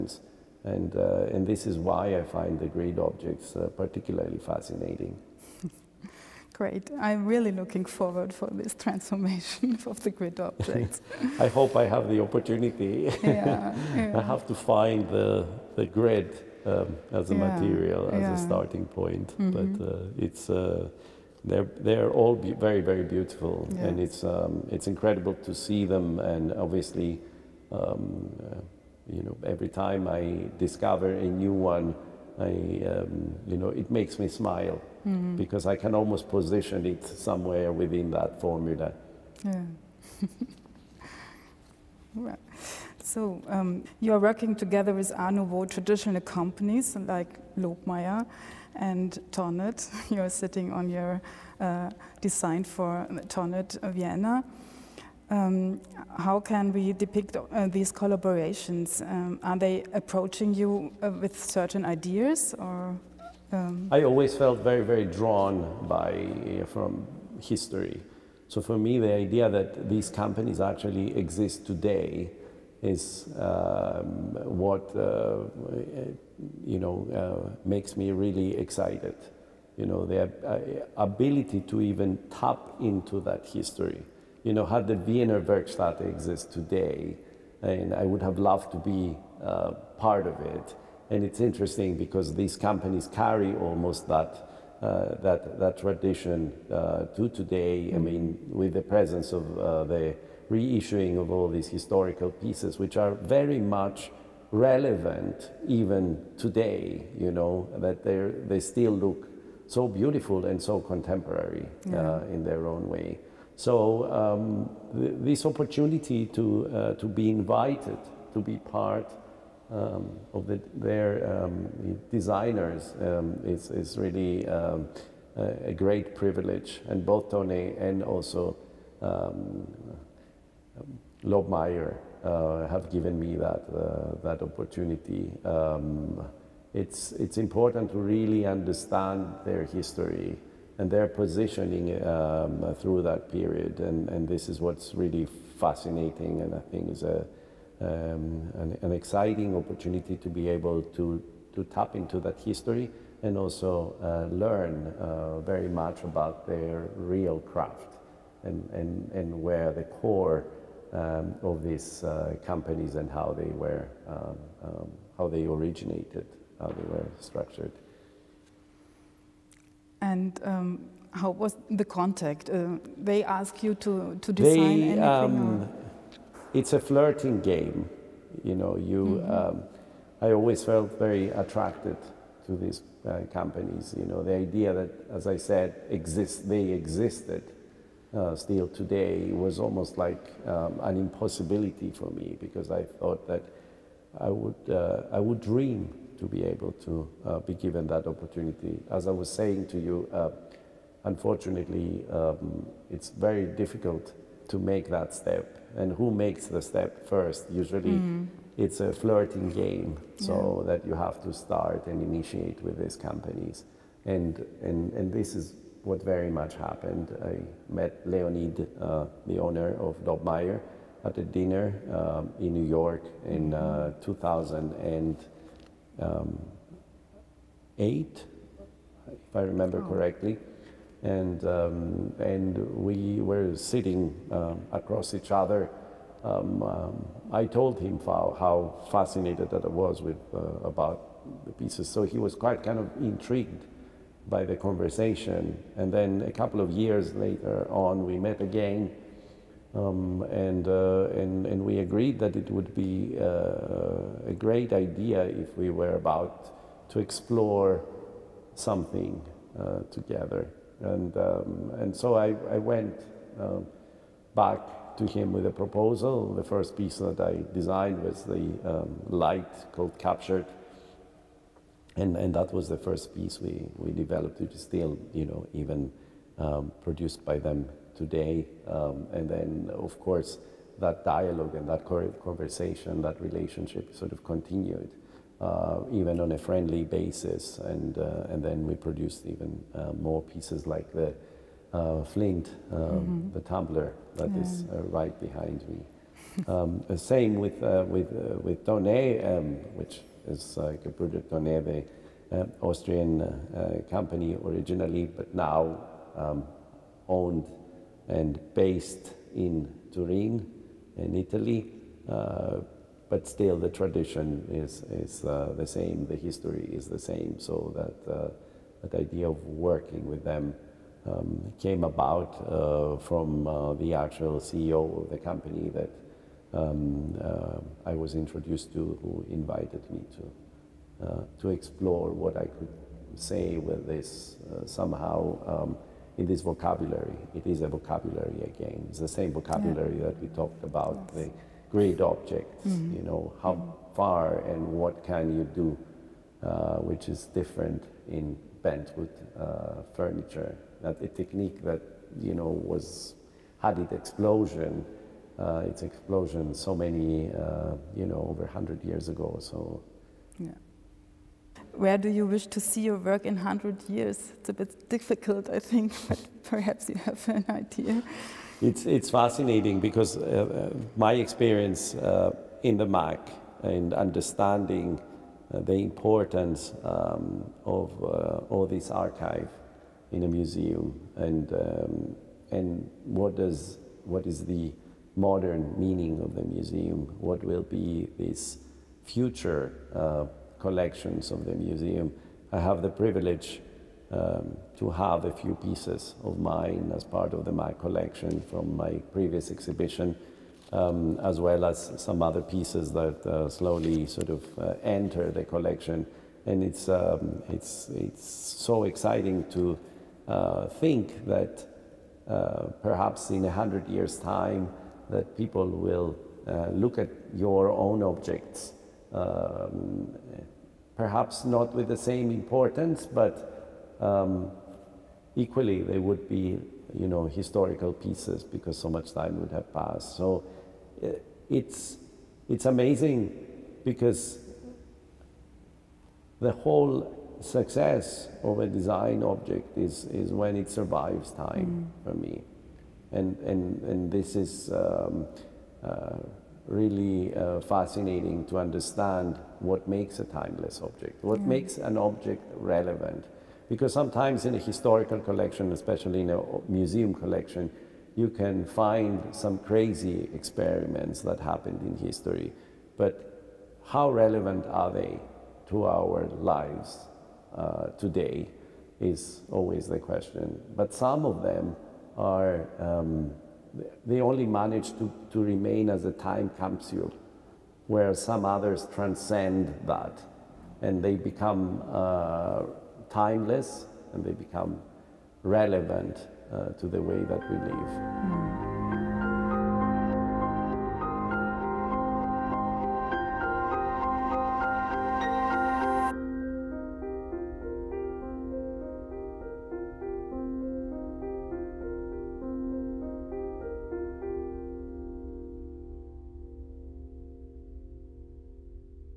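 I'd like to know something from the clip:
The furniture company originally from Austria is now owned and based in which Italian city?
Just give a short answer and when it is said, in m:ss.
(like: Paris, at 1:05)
Turin, at 5:09.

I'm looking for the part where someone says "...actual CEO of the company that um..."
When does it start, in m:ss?
5:23.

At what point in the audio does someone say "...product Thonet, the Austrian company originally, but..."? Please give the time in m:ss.
5:00.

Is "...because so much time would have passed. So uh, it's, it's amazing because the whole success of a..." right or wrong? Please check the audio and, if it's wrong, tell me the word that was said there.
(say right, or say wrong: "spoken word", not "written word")
right.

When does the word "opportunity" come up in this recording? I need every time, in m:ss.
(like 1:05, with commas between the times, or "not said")
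0:12, 1:55, 2:14, 2:29, 3:18.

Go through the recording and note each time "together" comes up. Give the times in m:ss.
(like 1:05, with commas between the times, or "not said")
0:44, 4:19.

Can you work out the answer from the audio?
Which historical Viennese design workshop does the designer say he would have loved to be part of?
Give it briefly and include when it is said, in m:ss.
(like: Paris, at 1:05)
Wiener Werkstatt, at 1:24.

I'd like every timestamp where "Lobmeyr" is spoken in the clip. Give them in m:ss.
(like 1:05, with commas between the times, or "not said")
0:47, 2:11, 3:40.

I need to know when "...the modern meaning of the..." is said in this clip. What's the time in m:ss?
6:24.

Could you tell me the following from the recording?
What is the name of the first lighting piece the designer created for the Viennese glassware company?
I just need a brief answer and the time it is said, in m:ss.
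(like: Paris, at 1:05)
Captured, at 4:29.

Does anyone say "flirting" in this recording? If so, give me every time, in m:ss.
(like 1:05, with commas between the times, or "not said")
2:56, 3:28.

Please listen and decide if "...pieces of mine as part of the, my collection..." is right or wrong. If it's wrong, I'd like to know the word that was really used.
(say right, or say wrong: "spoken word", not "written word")
right.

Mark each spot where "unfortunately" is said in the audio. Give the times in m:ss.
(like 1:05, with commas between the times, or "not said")
3:21.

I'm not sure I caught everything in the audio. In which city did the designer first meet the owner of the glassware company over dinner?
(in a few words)
New York.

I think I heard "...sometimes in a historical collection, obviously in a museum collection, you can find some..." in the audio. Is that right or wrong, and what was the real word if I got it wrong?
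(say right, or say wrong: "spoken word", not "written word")
wrong: "especially", not "obviously".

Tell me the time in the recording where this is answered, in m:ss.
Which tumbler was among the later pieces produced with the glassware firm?
4:52.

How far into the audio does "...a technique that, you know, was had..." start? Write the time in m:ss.
5:51.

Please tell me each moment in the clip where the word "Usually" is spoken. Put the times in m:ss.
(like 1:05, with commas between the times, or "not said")
3:27.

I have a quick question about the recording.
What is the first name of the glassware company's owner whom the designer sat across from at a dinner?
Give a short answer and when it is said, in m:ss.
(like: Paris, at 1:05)
Leonid, at 3:38.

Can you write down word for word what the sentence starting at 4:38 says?
Um, and then, of course, that dialogue and that conversation, that relationship sort of continued, uh, even on a friendly basis.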